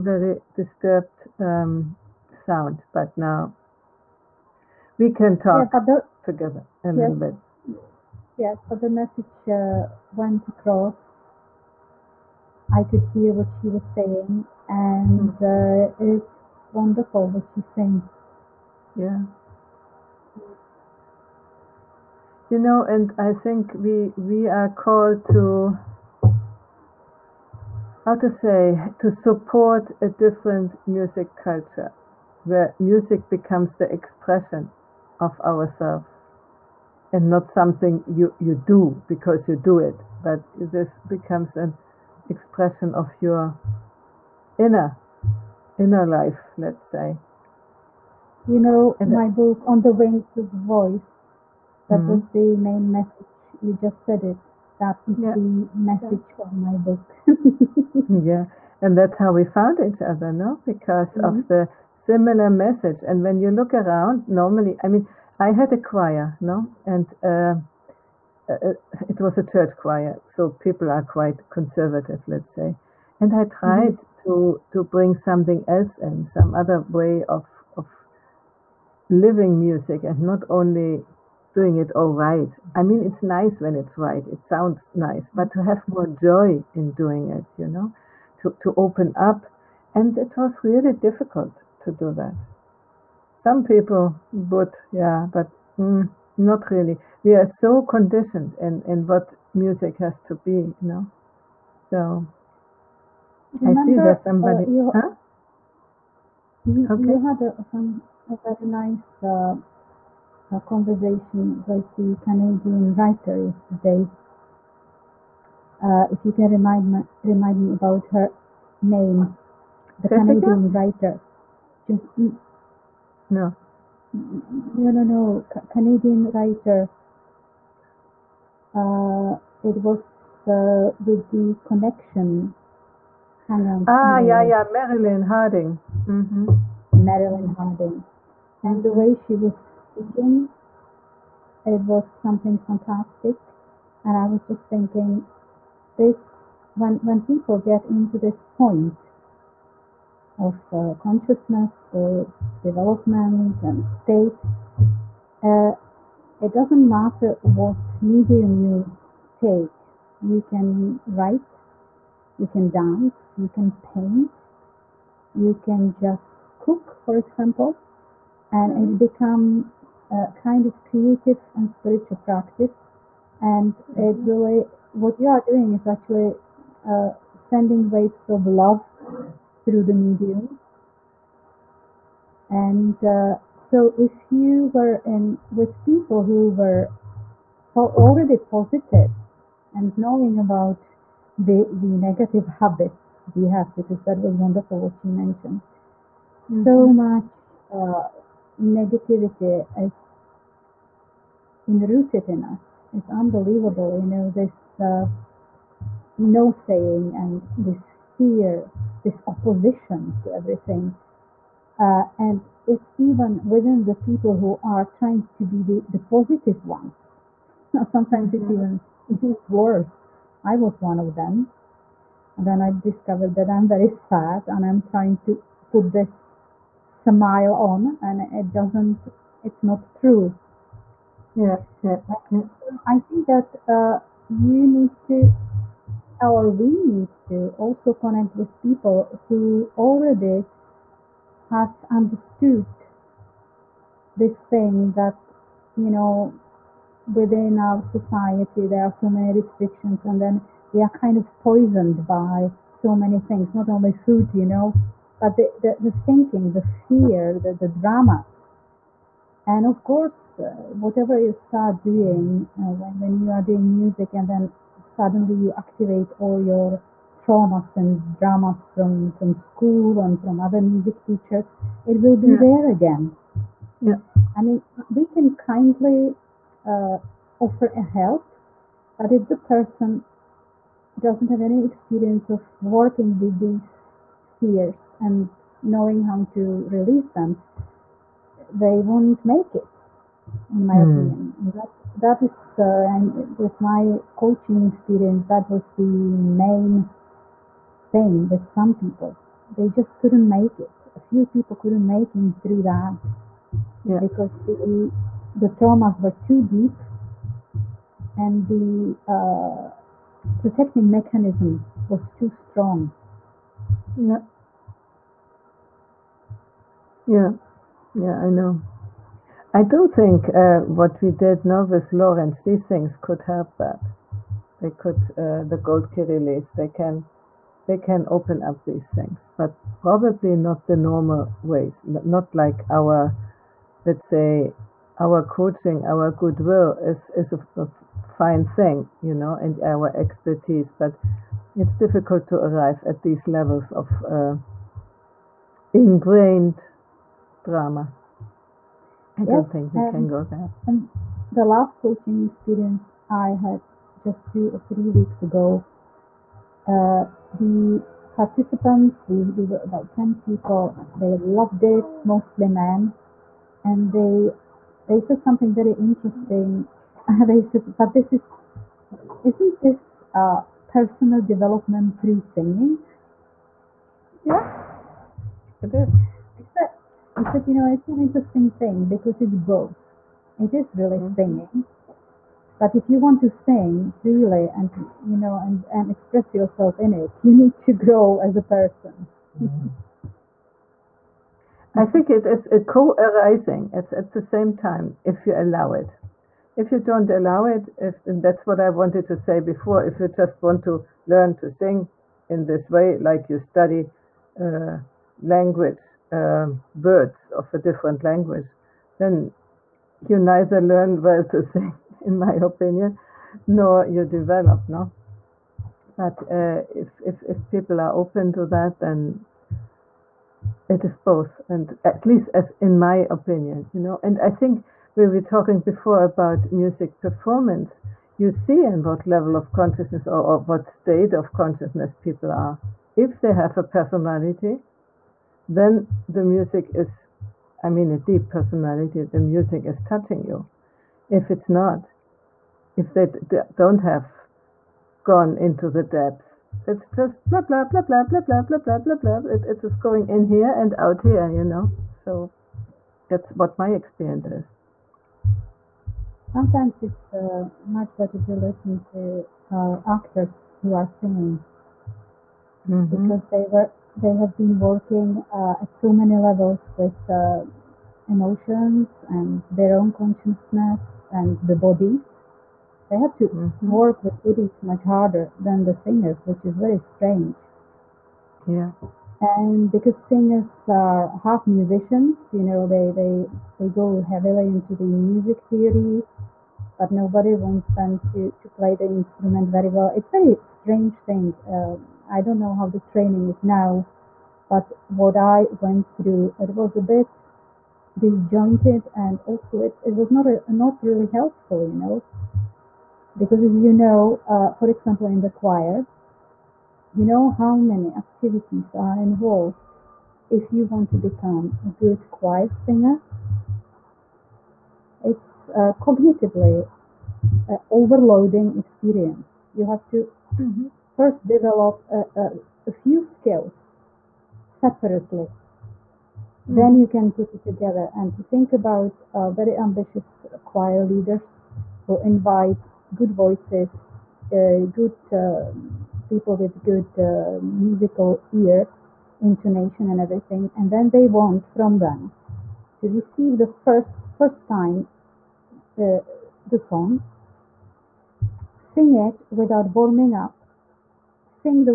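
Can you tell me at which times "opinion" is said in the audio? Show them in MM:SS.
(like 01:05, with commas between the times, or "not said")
04:50, 06:52, 07:03.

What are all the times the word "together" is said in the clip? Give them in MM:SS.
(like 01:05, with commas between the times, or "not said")
00:06, 08:47.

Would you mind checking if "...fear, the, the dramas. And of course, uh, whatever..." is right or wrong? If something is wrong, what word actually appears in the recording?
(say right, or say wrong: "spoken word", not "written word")
right.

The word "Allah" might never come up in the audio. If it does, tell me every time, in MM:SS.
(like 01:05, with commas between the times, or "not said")
not said.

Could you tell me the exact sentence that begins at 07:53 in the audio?
work with woodies much harder than the singers, which is very strange.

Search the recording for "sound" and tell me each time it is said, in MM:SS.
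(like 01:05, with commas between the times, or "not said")
00:02, 01:24.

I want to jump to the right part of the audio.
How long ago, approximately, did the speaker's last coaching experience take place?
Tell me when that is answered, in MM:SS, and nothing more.
05:54.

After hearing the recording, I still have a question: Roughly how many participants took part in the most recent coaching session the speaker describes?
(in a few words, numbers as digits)
10.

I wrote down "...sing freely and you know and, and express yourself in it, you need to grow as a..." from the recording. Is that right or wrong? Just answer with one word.
right.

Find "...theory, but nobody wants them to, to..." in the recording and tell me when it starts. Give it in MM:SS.
08:05.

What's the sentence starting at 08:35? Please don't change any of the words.
It's uh, cognitively uh, overloading experience.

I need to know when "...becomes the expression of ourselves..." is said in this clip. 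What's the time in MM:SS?
00:33.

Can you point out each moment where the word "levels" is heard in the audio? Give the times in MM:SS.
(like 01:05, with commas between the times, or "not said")
05:43, 07:09, 07:46.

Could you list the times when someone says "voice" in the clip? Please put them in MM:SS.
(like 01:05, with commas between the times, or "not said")
00:50, 08:53.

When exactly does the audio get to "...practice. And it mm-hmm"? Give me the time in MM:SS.
02:52.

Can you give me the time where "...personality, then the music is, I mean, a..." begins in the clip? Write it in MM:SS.
07:13.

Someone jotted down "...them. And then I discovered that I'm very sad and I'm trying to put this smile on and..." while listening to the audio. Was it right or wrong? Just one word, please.
right.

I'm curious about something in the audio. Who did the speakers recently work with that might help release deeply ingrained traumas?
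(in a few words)
Lawrence.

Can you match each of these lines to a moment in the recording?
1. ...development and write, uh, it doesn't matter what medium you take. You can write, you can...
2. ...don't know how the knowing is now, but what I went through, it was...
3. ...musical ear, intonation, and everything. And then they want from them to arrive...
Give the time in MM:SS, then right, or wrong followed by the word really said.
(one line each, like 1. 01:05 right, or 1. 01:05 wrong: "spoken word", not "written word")
1. 02:32 wrong: "state", not "write"
2. 08:12 wrong: "training", not "knowing"
3. 08:57 wrong: "receive", not "arrive".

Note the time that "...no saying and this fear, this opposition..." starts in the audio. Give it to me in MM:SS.
03:26.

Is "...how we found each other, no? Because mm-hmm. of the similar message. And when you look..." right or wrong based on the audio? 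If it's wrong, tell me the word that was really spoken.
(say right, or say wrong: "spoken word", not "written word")
right.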